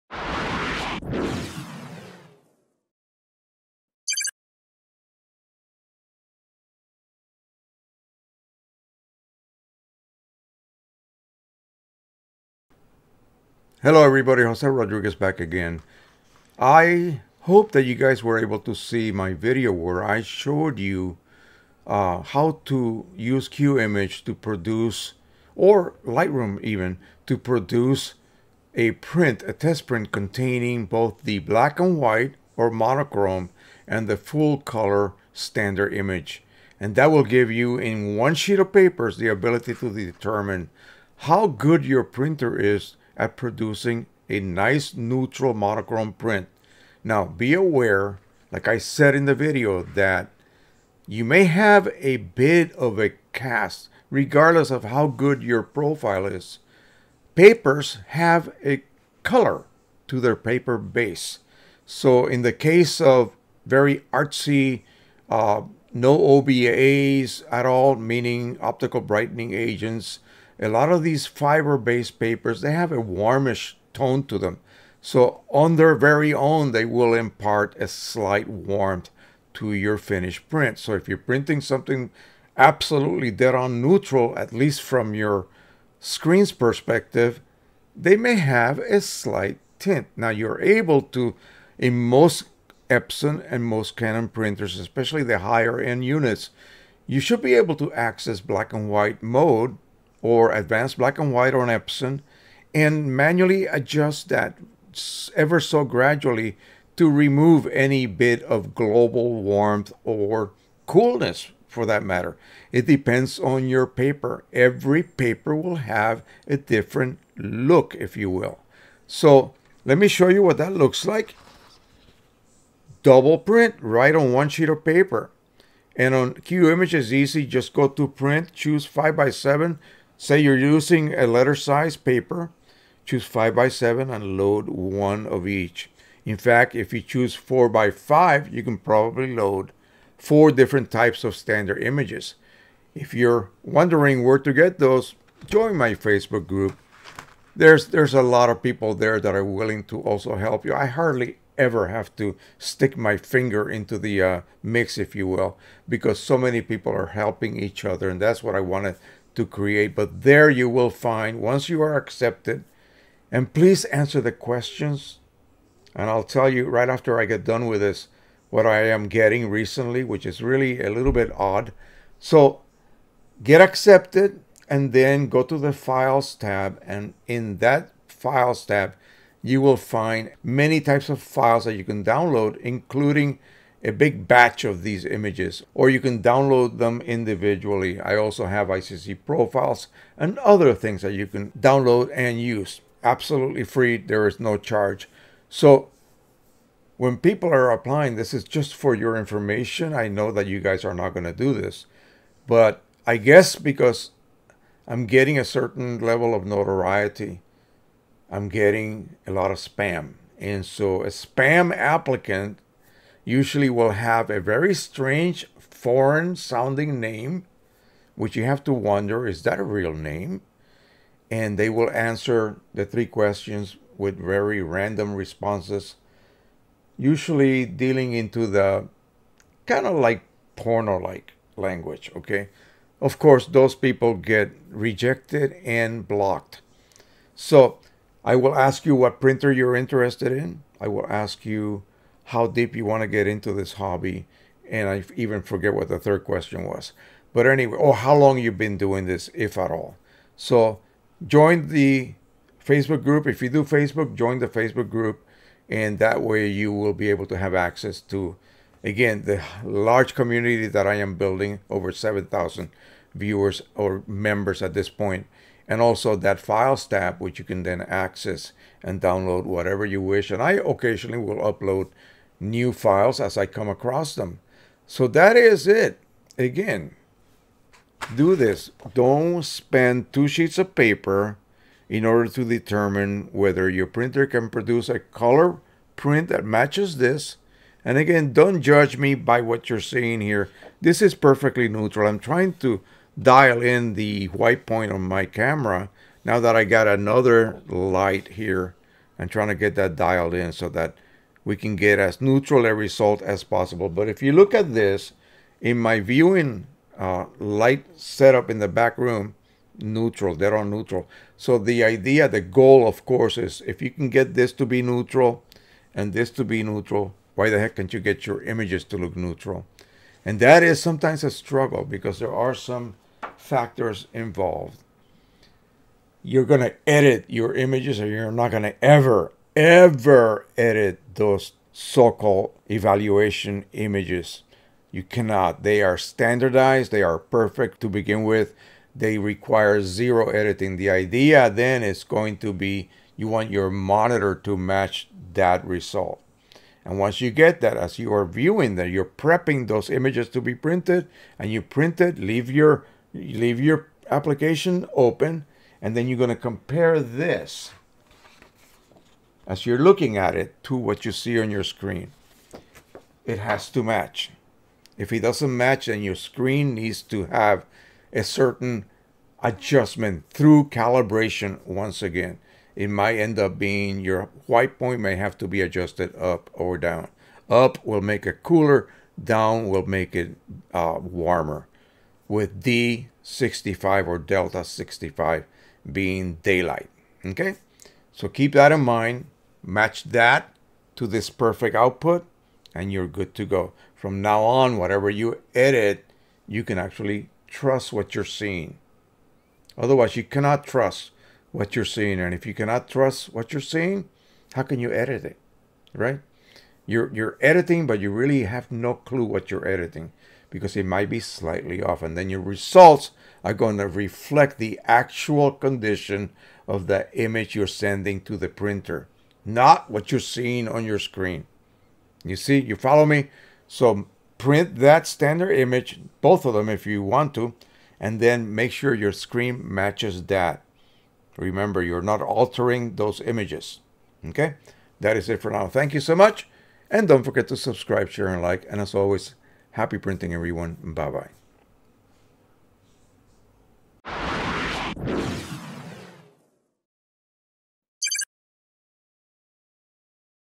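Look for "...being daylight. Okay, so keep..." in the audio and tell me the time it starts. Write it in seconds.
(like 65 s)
385 s.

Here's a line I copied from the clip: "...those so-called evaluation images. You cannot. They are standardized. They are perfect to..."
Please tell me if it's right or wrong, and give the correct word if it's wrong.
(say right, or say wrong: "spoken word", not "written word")
right.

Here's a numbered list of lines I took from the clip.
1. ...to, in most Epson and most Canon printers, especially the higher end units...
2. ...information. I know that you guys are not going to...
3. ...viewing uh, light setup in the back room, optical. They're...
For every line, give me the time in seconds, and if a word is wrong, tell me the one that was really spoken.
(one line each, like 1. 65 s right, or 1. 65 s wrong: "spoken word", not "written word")
1. 91 s right
2. 199 s right
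3. 305 s wrong: "neutral", not "optical".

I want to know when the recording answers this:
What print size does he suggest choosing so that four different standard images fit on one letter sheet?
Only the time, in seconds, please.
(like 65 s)
137 s.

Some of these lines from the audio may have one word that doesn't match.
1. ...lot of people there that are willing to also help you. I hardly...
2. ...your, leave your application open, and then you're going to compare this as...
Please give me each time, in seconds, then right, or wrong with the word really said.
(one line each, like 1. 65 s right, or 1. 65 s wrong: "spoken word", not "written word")
1. 148 s right
2. 352 s right.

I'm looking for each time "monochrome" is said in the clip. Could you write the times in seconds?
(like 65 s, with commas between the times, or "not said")
32 s, 45 s.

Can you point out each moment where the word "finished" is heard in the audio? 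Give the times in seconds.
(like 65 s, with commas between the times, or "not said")
79 s.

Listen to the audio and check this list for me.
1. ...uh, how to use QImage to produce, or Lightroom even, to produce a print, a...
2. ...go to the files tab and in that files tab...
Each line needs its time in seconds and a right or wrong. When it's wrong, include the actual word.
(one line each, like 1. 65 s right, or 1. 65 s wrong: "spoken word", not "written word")
1. 21 s right
2. 175 s right.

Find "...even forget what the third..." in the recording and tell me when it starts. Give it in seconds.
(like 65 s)
245 s.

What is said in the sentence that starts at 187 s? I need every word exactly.
I also have ICC profiles and other things that you can download and use.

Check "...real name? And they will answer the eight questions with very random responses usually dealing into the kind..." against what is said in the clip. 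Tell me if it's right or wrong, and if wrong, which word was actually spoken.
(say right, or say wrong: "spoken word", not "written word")
wrong: "three", not "eight".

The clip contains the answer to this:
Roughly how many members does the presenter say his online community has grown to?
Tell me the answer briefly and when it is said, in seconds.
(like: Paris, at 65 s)
over 7,000, at 261 s.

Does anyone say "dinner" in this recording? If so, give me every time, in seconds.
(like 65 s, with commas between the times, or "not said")
not said.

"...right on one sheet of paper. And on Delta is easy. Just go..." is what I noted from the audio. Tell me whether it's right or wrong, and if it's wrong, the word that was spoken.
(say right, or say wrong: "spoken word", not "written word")
wrong: "QImage", not "Delta".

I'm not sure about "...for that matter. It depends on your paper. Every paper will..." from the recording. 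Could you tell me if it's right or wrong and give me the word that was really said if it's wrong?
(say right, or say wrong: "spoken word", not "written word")
right.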